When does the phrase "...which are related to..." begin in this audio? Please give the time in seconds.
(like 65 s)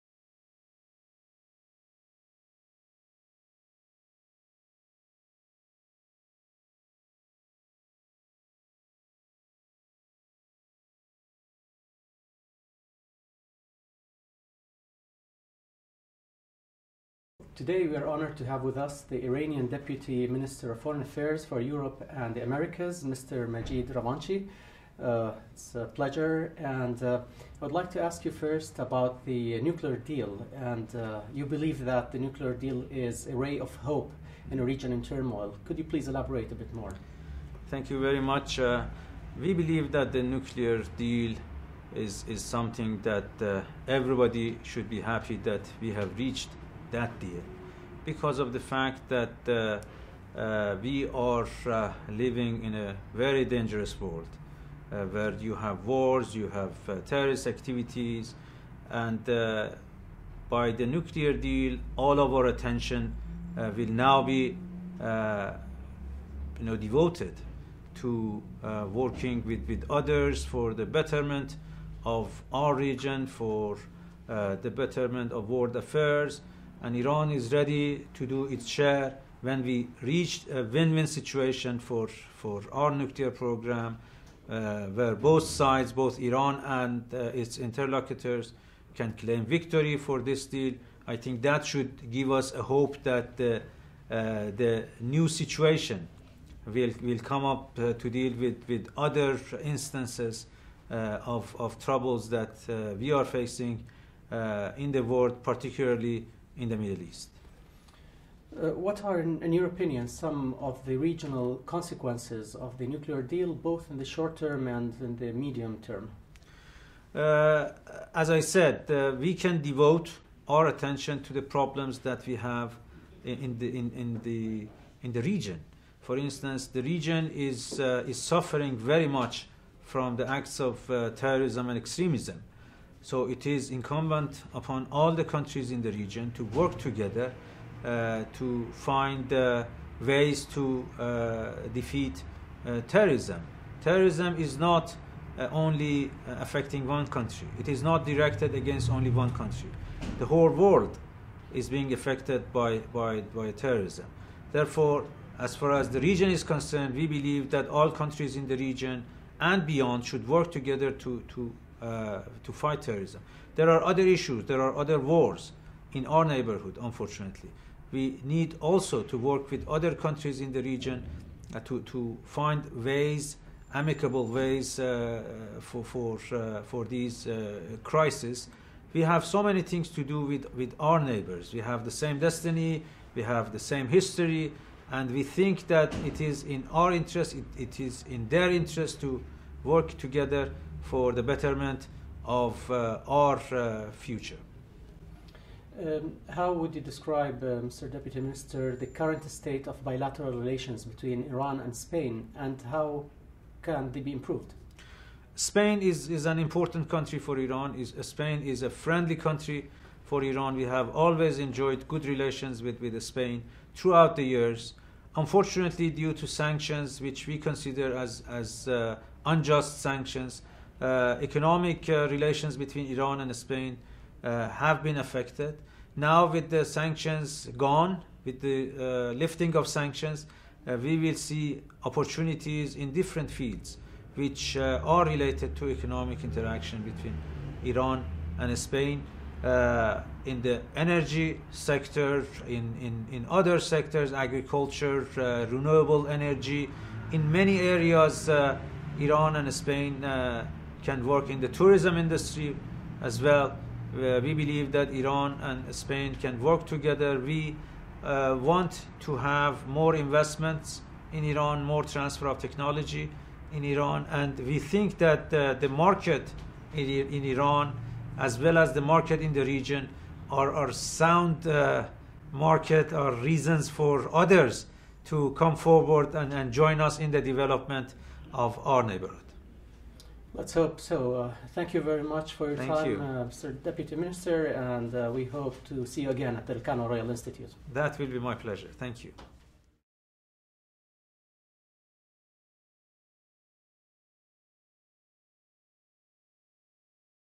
234 s.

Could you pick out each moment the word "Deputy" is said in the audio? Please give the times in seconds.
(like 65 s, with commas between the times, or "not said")
19 s, 197 s, 283 s.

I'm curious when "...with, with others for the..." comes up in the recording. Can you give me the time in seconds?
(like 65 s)
69 s.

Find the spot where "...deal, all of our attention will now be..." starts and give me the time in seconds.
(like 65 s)
61 s.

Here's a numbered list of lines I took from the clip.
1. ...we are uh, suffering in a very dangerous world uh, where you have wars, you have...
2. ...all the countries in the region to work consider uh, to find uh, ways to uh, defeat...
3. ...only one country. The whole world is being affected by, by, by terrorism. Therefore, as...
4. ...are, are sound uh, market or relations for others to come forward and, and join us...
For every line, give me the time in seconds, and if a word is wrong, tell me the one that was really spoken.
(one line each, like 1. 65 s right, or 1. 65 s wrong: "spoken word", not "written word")
1. 50 s wrong: "living", not "suffering"
2. 134 s wrong: "together", not "consider"
3. 148 s right
4. 270 s wrong: "reasons", not "relations".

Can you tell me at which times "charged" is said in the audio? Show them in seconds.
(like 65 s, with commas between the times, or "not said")
not said.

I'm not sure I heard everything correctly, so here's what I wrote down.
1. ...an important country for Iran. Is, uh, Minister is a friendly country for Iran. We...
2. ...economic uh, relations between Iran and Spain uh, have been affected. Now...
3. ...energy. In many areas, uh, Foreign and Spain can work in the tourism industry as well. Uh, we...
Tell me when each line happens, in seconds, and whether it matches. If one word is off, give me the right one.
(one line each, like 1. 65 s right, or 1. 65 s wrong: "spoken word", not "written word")
1. 206 s wrong: "Spain", not "Minister"
2. 221 s right
3. 246 s wrong: "Iran", not "Foreign".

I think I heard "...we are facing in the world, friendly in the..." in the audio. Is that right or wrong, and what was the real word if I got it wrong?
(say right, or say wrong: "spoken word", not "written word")
wrong: "particularly", not "friendly".